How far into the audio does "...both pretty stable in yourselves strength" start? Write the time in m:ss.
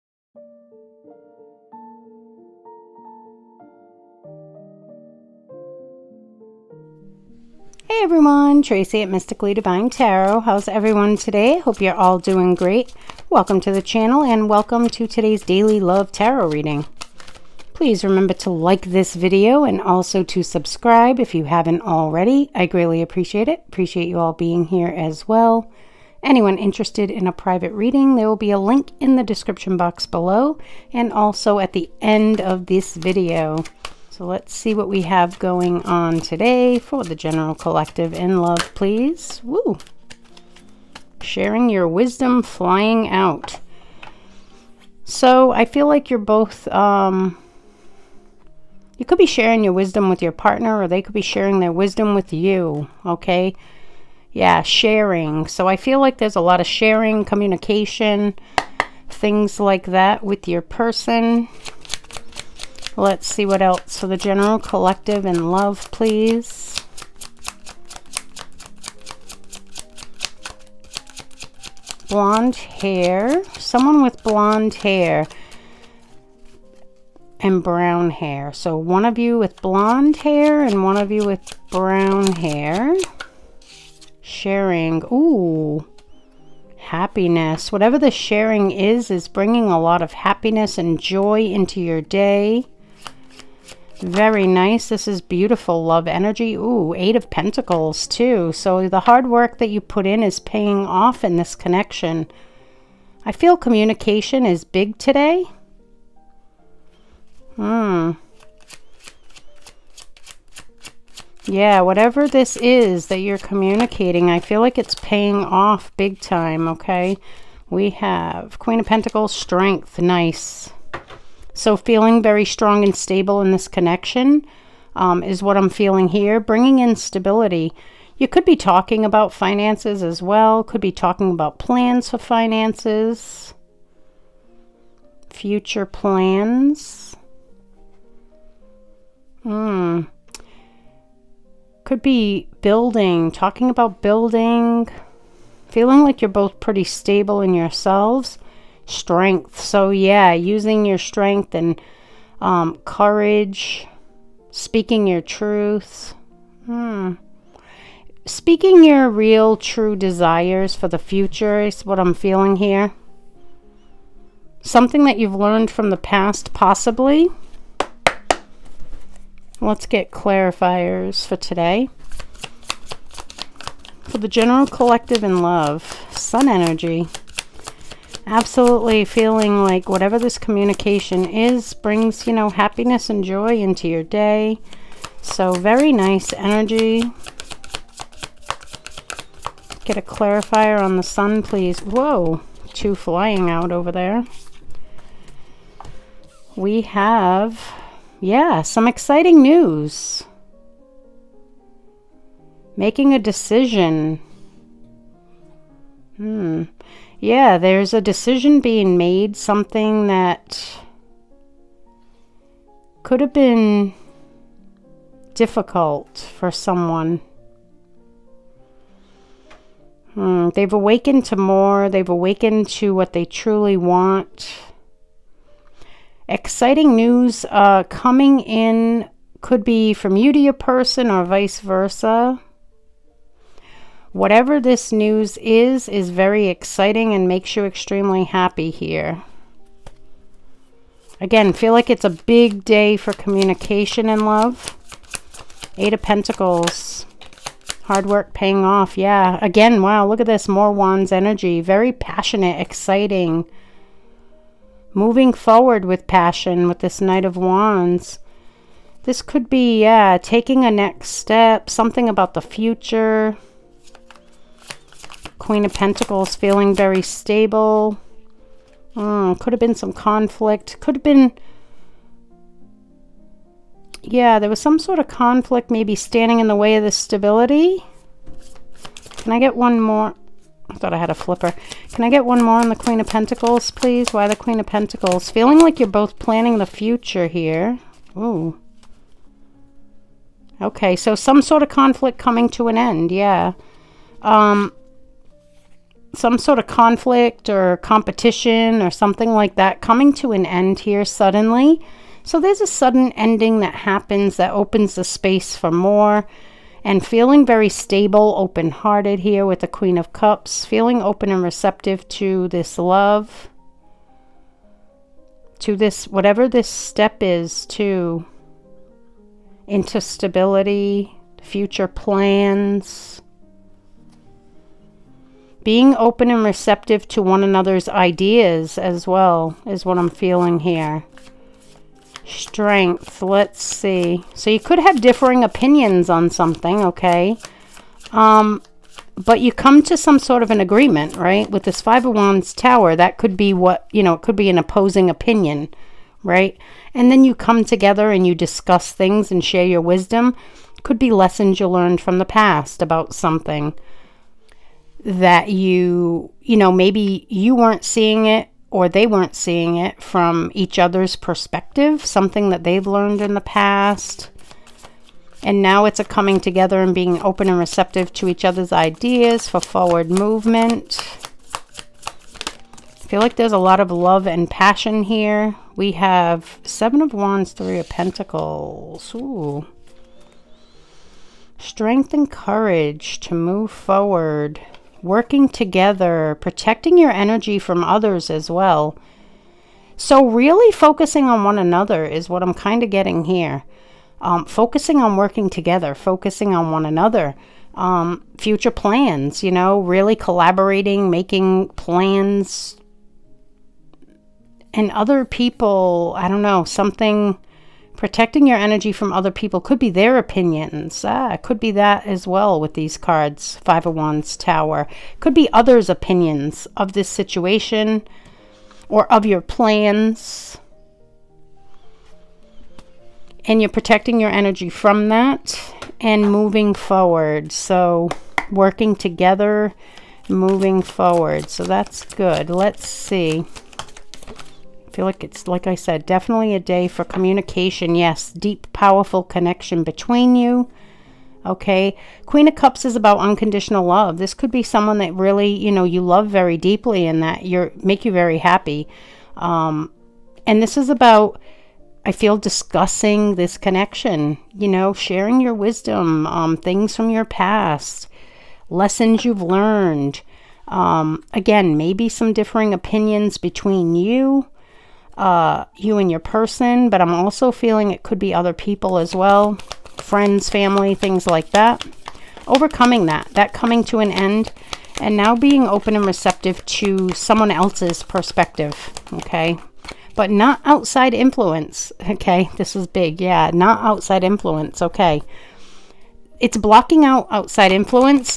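2:26.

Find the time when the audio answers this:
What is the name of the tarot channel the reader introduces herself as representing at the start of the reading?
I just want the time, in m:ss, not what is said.
0:09.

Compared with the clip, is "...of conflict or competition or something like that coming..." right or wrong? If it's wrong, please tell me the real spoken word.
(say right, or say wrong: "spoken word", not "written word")
right.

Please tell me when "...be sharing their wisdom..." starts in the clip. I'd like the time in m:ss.
0:51.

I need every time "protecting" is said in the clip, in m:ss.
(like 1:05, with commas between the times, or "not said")
6:26, 6:48, 7:03.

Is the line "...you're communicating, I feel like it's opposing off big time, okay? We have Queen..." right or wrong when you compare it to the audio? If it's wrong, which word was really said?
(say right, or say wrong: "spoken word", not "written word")
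wrong: "paying", not "opposing".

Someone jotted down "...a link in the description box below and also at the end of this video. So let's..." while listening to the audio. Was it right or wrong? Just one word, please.
right.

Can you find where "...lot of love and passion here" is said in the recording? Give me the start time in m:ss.
6:13.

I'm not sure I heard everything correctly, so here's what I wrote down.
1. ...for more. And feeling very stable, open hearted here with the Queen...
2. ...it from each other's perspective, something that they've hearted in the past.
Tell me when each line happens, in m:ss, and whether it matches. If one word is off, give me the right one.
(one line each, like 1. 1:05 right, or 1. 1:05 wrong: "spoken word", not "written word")
1. 5:05 right
2. 5:59 wrong: "learned", not "hearted".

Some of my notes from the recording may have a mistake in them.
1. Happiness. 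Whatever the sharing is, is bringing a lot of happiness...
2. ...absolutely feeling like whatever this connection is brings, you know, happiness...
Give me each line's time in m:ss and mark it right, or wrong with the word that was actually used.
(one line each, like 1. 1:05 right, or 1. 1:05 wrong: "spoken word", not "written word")
1. 1:26 right
2. 2:58 wrong: "communication", not "connection".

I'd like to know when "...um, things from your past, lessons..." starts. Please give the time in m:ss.
7:36.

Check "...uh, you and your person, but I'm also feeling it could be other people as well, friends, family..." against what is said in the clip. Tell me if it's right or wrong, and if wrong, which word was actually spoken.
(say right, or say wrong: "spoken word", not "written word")
right.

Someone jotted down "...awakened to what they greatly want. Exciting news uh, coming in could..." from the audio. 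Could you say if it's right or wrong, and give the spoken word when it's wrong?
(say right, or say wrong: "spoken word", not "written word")
wrong: "truly", not "greatly".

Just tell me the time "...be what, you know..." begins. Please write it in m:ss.
5:43.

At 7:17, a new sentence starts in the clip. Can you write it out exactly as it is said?
Yes, deep, powerful connection between you.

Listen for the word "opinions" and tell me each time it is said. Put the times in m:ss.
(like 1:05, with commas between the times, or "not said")
5:35, 5:45, 6:50, 6:55, 7:42.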